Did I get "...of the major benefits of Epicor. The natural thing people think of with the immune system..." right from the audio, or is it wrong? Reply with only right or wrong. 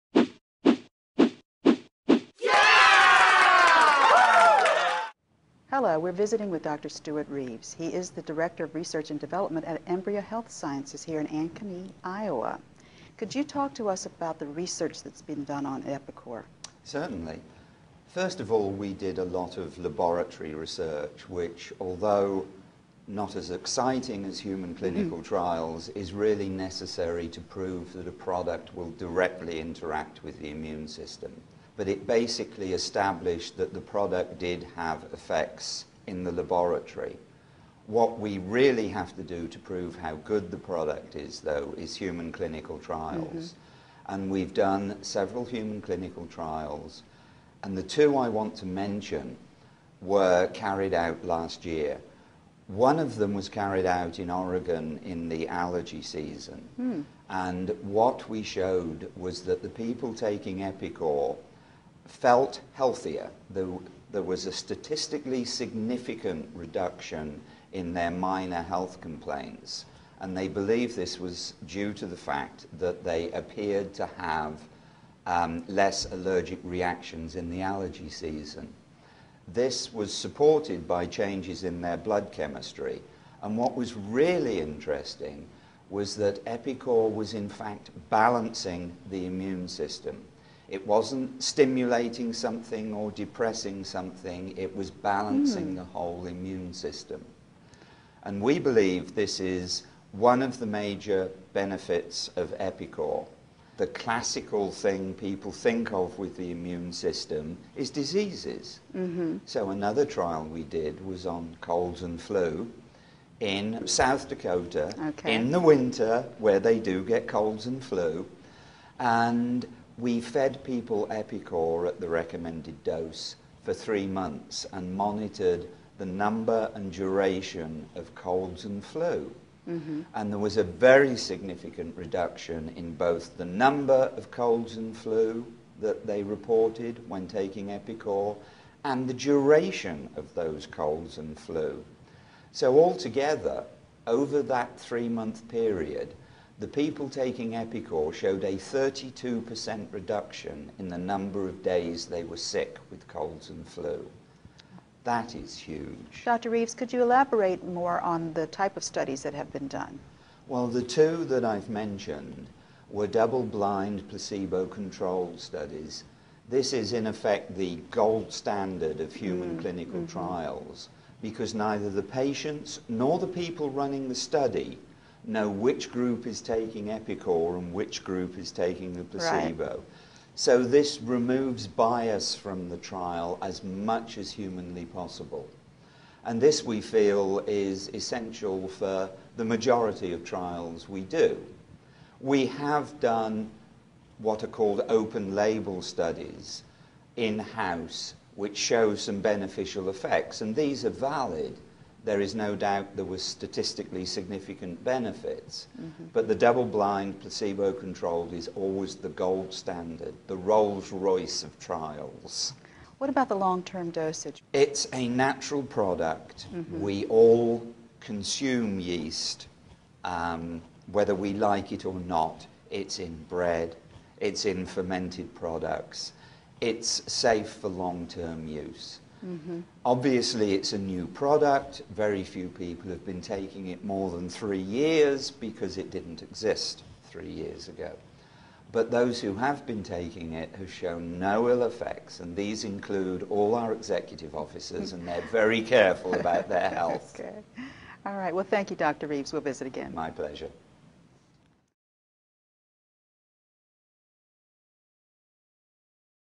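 wrong.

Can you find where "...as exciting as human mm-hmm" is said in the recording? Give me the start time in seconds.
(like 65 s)
23 s.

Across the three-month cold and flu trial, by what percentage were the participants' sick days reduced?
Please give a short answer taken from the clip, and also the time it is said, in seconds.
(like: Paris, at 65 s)
32%, at 148 s.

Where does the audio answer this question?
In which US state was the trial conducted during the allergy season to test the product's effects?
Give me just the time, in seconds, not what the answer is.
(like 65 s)
54 s.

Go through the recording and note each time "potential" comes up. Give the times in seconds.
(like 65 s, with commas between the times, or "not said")
not said.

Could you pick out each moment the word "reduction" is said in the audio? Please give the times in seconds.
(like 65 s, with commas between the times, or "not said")
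66 s, 131 s, 149 s.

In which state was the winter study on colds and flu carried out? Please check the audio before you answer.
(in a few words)
South Dakota.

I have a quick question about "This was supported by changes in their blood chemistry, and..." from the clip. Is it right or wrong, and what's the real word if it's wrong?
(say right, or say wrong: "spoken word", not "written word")
right.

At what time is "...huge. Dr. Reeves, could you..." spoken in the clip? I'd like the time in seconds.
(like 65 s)
155 s.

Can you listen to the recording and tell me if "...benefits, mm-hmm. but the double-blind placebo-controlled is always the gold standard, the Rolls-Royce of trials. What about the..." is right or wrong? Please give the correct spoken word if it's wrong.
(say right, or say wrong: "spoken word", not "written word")
right.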